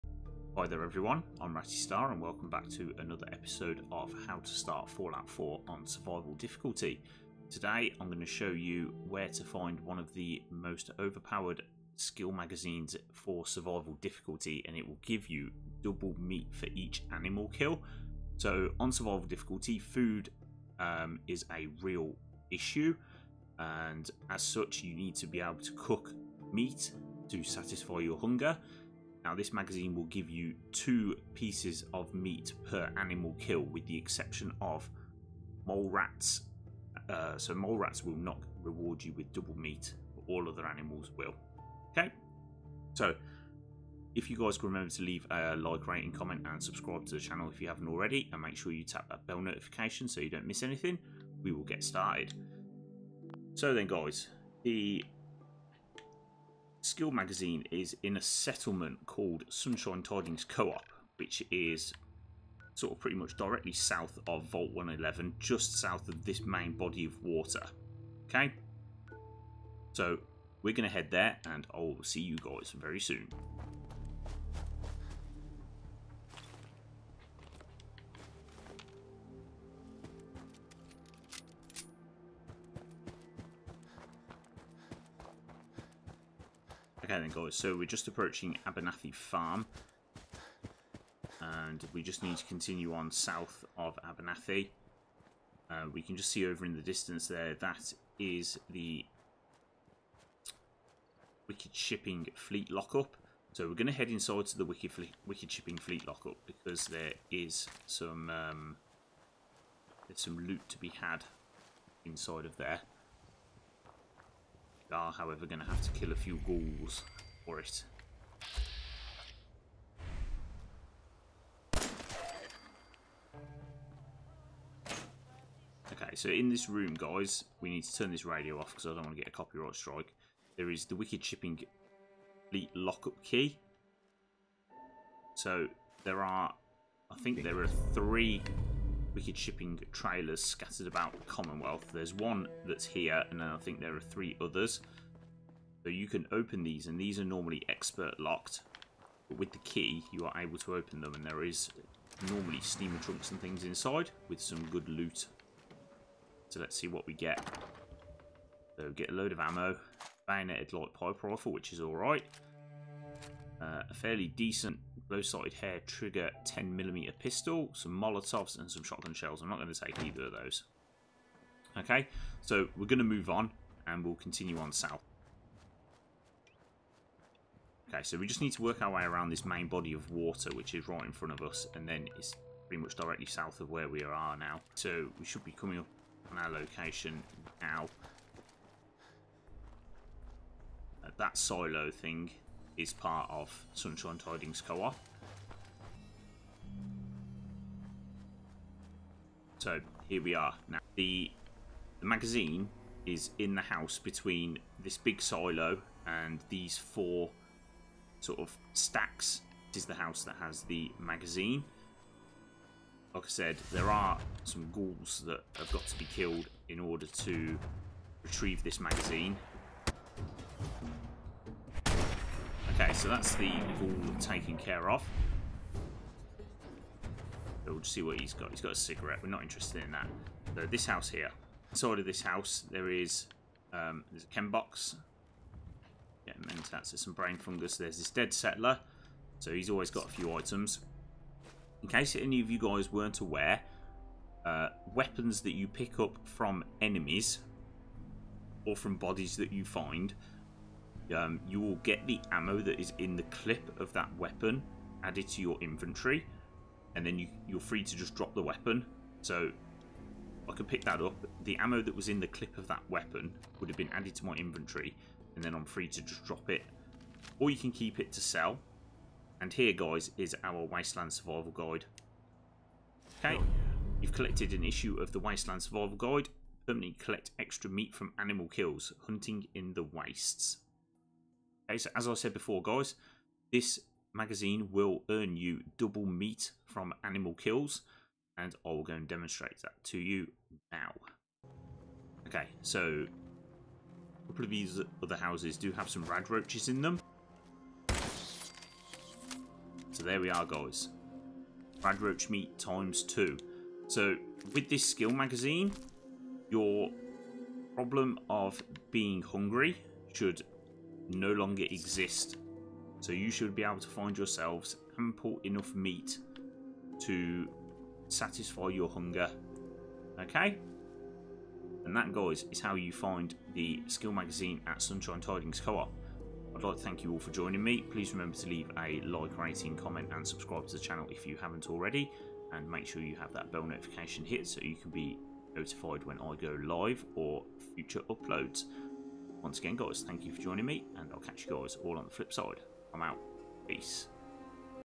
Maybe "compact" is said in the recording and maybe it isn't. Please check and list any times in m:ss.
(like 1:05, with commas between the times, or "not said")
not said.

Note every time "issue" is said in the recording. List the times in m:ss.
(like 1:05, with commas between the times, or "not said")
0:22, 4:34.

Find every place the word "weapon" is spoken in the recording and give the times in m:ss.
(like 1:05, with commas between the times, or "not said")
4:04, 4:14, 4:18, 4:22.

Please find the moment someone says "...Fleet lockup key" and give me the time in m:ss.
2:12.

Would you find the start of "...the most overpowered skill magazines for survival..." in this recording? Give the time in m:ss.
0:10.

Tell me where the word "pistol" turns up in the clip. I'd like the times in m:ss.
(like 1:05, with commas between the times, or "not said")
2:47.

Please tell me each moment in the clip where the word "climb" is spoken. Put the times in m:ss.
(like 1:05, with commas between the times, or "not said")
not said.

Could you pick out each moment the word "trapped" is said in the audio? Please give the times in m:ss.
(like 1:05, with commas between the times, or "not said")
not said.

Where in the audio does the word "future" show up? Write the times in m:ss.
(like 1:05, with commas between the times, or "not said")
5:37.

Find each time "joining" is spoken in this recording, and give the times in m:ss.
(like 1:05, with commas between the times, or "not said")
5:27, 5:40.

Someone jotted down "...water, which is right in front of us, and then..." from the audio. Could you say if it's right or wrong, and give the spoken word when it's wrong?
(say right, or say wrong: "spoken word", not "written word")
right.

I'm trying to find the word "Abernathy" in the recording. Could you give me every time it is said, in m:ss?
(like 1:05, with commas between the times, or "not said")
1:28, 1:34.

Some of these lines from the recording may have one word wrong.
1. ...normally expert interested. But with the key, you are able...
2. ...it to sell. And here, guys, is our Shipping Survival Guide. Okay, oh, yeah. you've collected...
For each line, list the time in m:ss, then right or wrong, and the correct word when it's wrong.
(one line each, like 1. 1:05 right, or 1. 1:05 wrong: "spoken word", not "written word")
1. 2:27 wrong: "locked", not "interested"
2. 4:27 wrong: "Wasteland", not "Shipping".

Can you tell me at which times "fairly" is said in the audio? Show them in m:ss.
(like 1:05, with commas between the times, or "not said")
2:43.